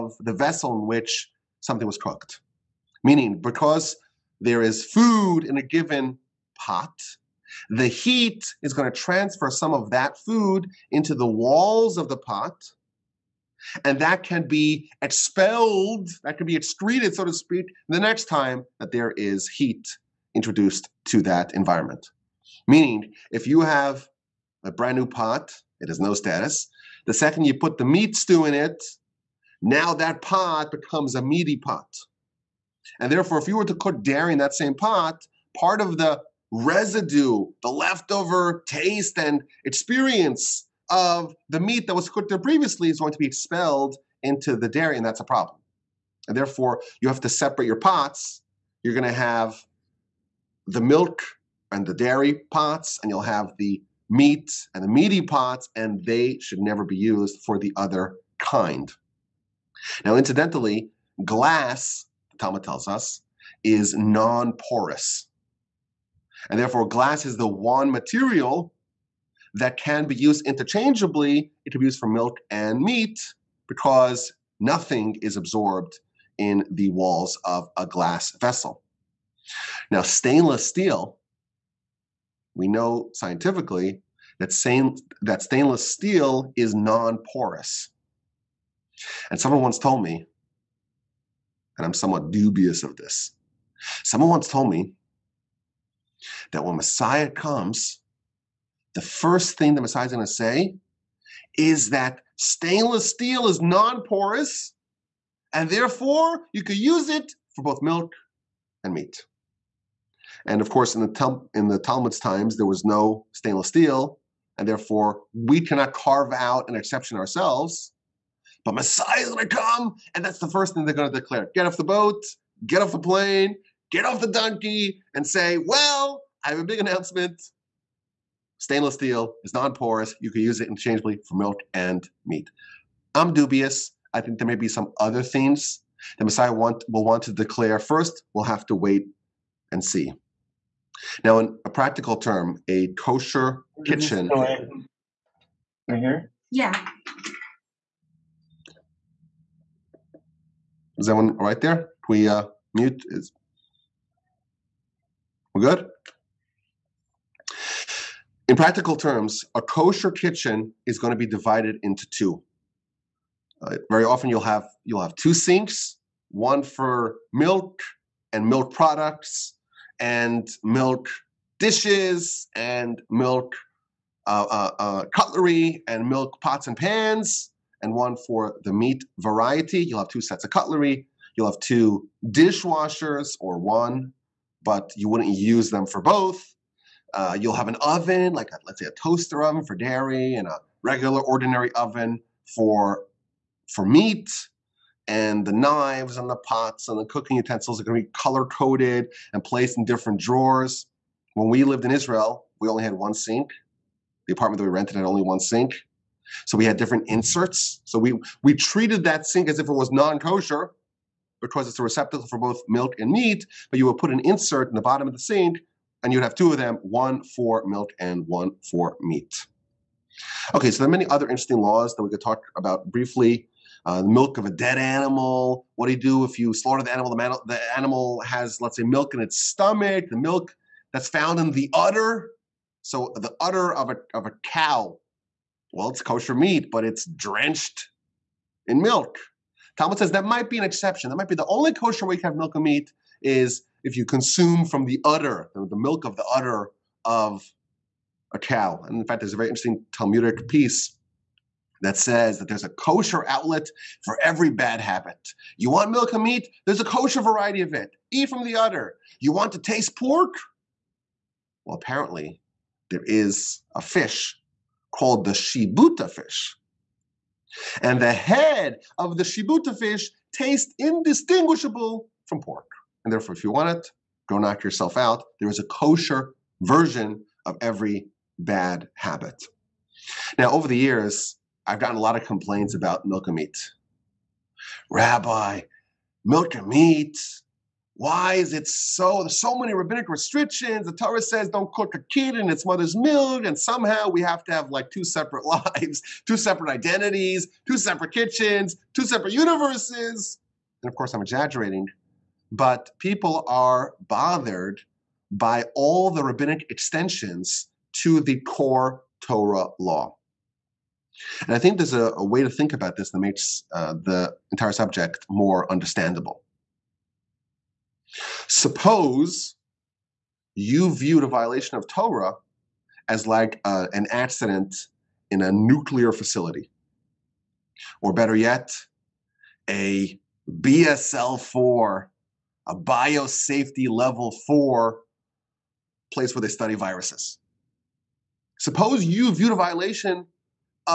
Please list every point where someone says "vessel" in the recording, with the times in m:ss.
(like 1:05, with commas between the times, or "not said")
0:00, 1:18.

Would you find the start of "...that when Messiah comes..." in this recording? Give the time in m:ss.
1:36.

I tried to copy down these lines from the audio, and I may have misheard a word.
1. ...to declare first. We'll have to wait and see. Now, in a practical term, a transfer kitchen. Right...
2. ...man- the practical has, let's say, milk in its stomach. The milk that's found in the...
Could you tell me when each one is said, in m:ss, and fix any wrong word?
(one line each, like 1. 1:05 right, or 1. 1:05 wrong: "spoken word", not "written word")
1. 2:17 wrong: "kosher", not "transfer"
2. 3:47 wrong: "animal", not "practical".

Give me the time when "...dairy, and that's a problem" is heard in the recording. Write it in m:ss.
0:44.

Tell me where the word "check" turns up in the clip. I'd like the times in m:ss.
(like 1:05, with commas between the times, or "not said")
not said.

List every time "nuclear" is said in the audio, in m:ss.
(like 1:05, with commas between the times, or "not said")
5:25.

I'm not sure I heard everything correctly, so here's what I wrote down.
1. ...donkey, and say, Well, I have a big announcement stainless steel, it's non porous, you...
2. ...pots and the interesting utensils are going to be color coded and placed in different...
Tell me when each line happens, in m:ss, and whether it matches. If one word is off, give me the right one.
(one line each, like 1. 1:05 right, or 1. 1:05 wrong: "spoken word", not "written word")
1. 2:04 right
2. 3:16 wrong: "cooking", not "interesting".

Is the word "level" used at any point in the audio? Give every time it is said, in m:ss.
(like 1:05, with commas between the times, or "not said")
5:33.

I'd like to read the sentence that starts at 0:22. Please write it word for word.
Meaning, if you have a brand new pot, it has no status.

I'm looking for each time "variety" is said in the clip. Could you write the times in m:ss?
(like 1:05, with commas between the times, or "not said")
2:59, 4:17.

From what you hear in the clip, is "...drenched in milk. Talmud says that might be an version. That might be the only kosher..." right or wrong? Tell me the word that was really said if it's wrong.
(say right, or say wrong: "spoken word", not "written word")
wrong: "exception", not "version".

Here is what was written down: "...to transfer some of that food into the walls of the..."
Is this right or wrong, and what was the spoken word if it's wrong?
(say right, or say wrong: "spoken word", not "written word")
right.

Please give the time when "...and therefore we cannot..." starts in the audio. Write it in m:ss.
1:54.